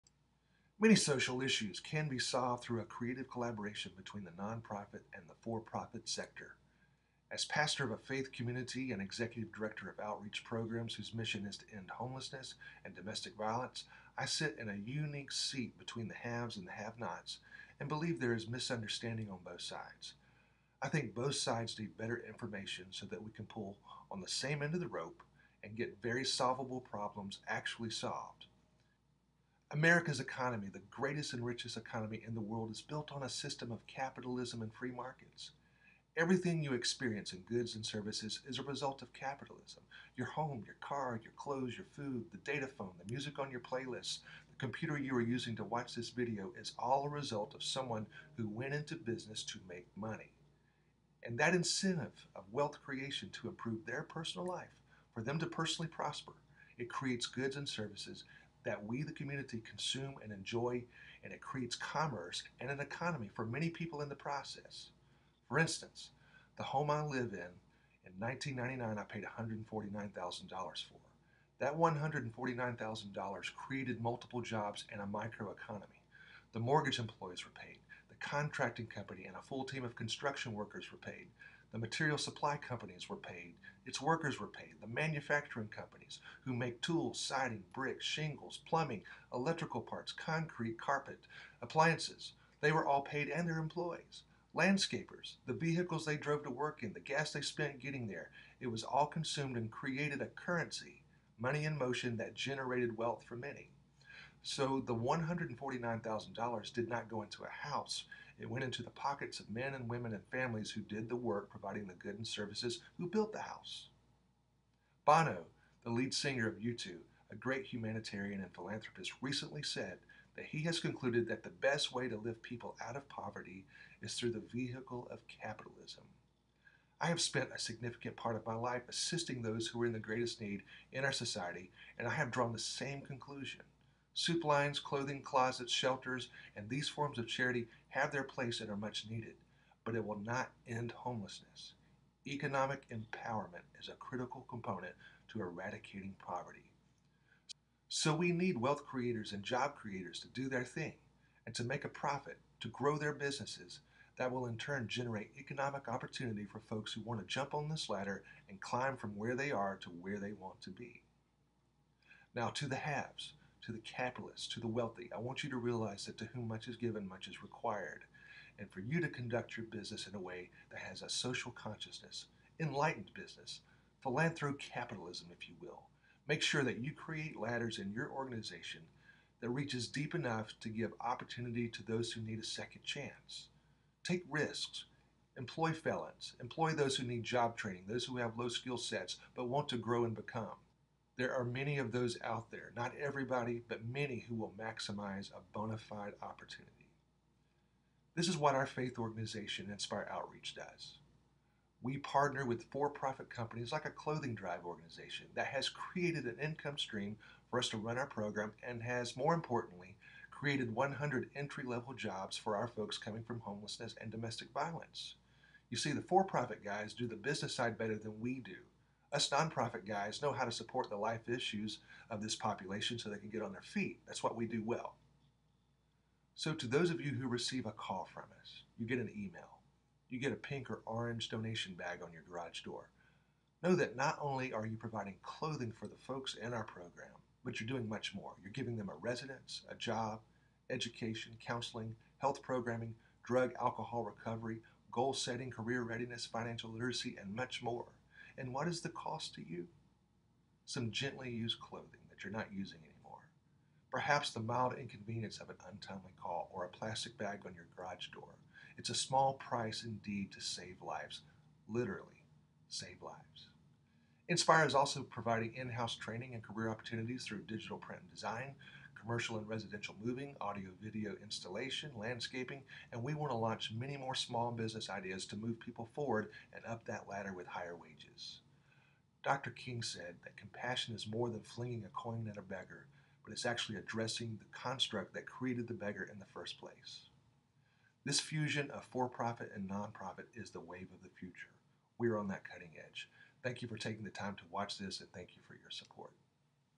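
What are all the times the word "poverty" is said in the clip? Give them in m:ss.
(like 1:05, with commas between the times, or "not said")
2:03, 2:26.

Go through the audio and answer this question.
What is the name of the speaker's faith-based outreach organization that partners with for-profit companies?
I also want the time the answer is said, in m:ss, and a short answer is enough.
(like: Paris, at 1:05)
Nspire Outreach, at 3:19.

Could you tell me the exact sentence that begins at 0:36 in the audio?
Everything you experience in goods and services is a result of capitalism.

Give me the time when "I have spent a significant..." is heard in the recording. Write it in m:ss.
2:06.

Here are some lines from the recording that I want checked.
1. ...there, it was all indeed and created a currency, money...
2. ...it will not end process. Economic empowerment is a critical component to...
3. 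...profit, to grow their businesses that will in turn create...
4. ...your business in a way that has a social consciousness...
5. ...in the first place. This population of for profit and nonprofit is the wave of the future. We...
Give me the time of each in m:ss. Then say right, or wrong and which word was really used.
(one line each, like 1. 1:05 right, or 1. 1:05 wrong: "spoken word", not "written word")
1. 1:38 wrong: "consumed", not "indeed"
2. 2:19 wrong: "homelessness", not "process"
3. 2:31 wrong: "generate", not "create"
4. 2:49 right
5. 4:46 wrong: "fusion", not "population".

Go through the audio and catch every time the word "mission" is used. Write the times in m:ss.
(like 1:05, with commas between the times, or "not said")
0:11.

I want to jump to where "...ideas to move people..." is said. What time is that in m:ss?
4:34.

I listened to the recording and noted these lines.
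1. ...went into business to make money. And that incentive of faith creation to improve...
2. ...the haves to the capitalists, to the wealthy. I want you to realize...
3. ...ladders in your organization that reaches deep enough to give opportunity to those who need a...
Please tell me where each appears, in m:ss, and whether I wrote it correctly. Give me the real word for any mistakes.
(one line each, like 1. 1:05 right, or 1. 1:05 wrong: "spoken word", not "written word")
1. 0:48 wrong: "wealth", not "faith"
2. 2:42 right
3. 2:57 right.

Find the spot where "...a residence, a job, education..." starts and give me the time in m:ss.
3:58.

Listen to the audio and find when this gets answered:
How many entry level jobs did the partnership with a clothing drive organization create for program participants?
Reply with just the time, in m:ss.
3:30.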